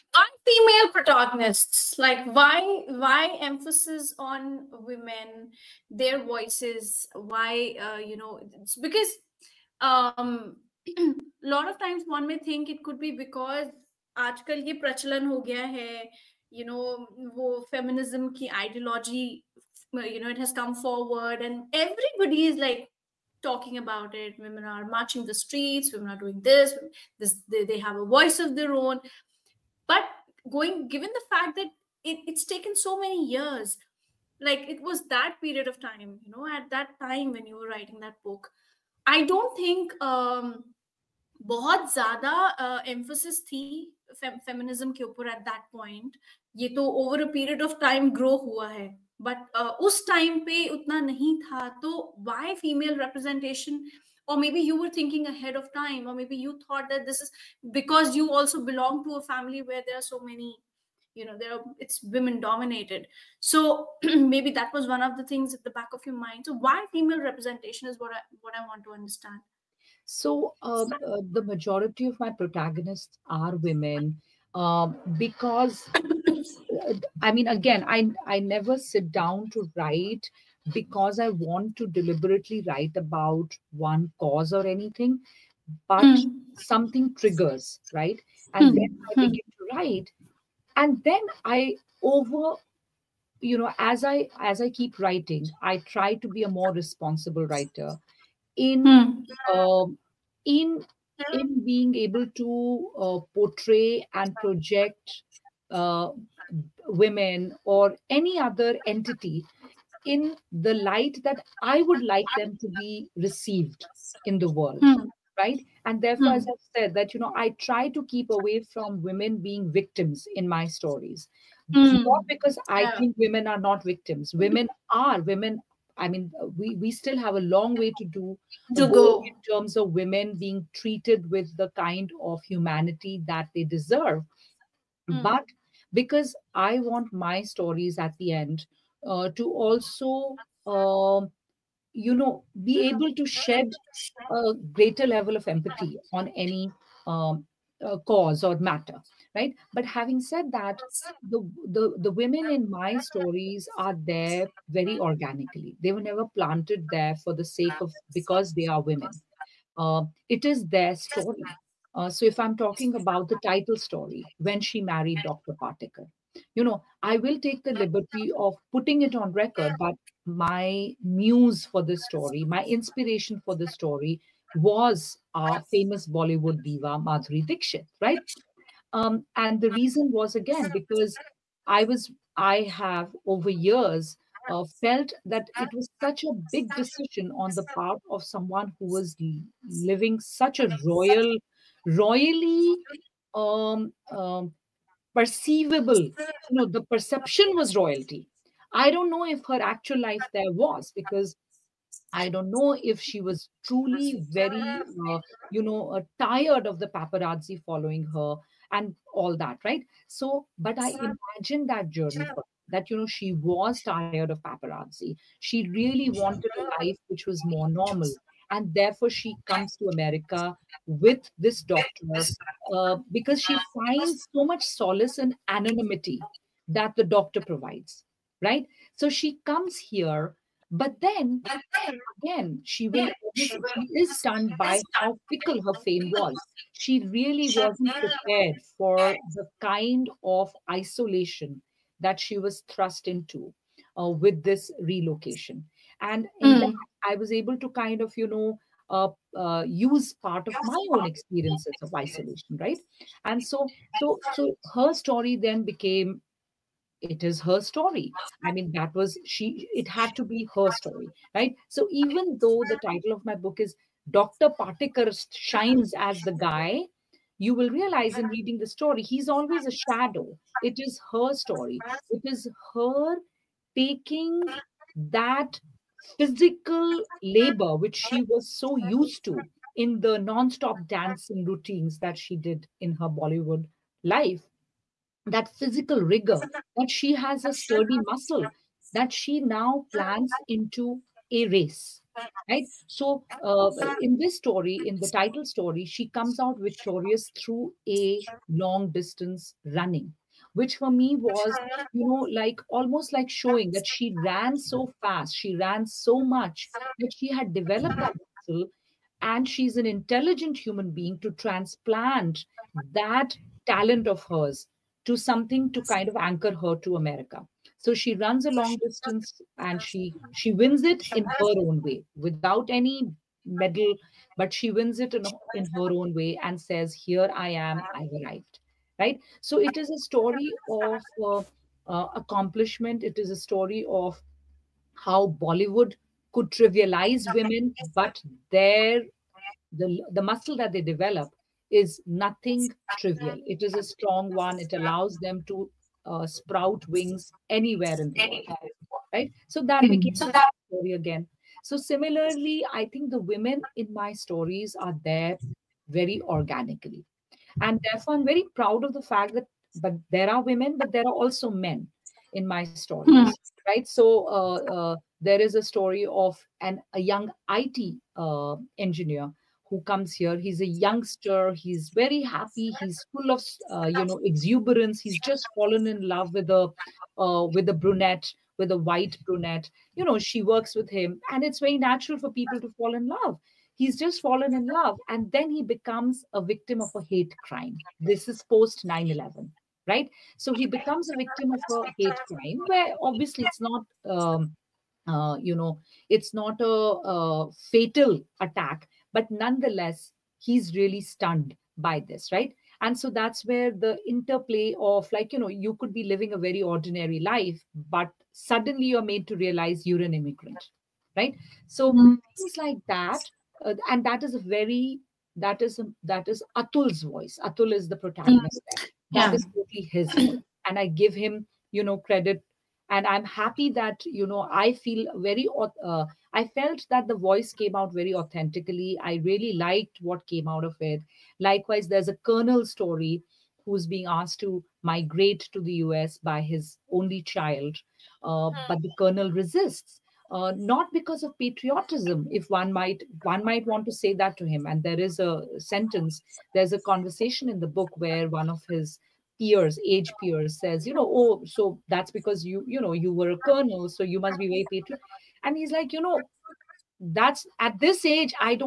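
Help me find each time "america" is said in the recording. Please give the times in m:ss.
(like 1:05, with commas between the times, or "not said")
3:39, 5:17.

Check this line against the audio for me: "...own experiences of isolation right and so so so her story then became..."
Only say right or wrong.
right.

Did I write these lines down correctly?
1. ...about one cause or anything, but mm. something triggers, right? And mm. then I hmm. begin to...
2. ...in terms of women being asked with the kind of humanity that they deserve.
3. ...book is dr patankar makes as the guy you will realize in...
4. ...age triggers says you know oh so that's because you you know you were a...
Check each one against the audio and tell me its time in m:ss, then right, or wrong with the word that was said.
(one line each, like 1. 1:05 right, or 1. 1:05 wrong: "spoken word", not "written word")
1. 1:22 right
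2. 2:09 wrong: "treated", not "asked"
3. 4:23 wrong: "shines", not "makes"
4. 7:29 wrong: "peers", not "triggers".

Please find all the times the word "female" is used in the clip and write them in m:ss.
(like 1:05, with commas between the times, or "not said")
0:00, 1:06.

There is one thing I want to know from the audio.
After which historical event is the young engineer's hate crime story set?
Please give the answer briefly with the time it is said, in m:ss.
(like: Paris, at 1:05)
9/11, at 6:28.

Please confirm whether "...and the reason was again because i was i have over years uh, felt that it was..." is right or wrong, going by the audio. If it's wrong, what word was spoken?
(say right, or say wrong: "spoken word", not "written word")
right.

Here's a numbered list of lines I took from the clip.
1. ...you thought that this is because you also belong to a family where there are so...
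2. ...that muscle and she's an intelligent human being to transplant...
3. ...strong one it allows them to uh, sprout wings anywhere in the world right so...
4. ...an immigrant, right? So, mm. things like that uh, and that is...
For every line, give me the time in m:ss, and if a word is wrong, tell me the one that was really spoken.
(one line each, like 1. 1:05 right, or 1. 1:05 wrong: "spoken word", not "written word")
1. 0:56 right
2. 5:08 right
3. 5:43 right
4. 6:50 right.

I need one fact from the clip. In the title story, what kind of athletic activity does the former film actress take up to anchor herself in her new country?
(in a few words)
Long distance running.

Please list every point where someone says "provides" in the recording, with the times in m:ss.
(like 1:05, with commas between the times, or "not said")
3:47.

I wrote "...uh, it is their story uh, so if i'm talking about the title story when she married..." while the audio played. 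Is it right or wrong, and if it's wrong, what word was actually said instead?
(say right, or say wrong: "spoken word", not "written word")
right.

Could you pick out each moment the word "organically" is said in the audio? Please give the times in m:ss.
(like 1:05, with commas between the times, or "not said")
2:34, 5:56.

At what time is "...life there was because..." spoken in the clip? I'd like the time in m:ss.
3:20.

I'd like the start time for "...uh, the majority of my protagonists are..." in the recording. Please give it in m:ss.
1:10.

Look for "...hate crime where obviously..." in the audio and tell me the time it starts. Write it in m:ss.
6:31.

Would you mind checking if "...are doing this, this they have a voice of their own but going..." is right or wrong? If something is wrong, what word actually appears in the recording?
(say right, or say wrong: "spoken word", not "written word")
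right.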